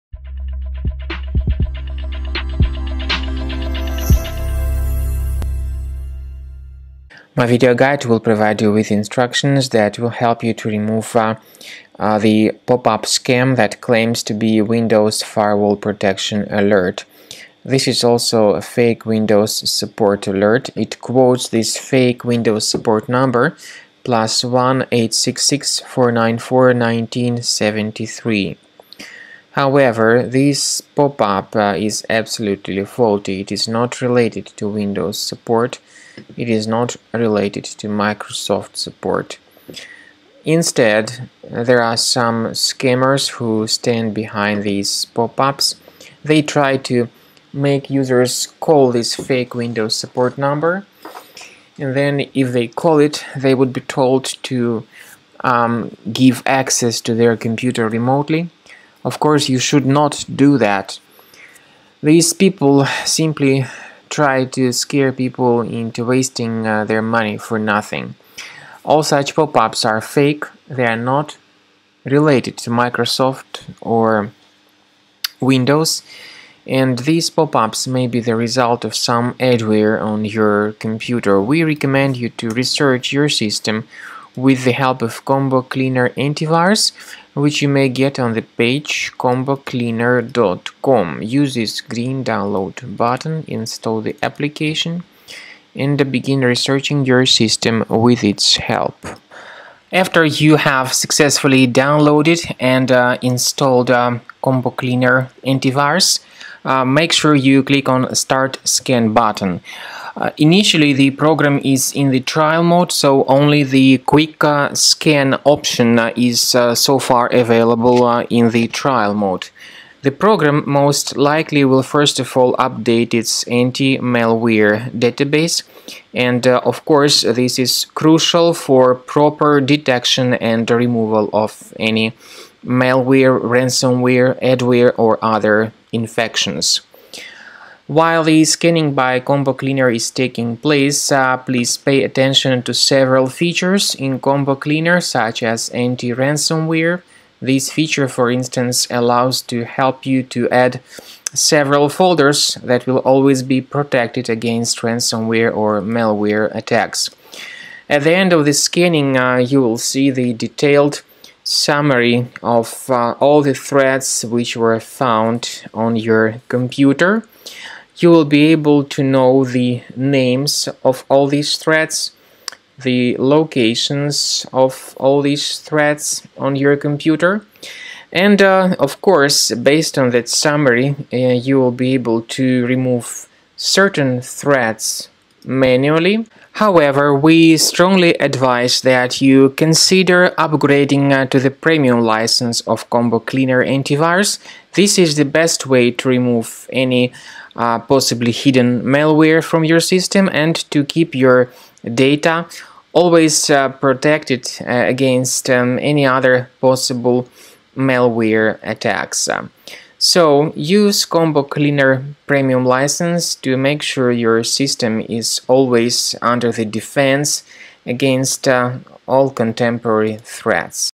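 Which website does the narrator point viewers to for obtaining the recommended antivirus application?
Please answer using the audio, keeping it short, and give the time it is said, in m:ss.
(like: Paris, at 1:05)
combocleaner.com, at 1:29.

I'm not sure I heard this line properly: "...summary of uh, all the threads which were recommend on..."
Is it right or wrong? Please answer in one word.
wrong.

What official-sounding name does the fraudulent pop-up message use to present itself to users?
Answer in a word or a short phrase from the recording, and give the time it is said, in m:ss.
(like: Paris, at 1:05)
Windows Firewall Protection Alert, at 0:14.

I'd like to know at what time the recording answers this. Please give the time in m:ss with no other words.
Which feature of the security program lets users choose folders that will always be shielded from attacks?
2:25.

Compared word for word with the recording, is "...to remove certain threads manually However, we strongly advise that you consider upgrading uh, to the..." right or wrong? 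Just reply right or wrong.
right.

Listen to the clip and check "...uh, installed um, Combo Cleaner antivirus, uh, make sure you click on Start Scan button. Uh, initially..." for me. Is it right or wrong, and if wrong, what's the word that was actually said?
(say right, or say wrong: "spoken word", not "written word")
right.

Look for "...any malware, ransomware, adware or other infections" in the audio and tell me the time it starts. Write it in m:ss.
2:11.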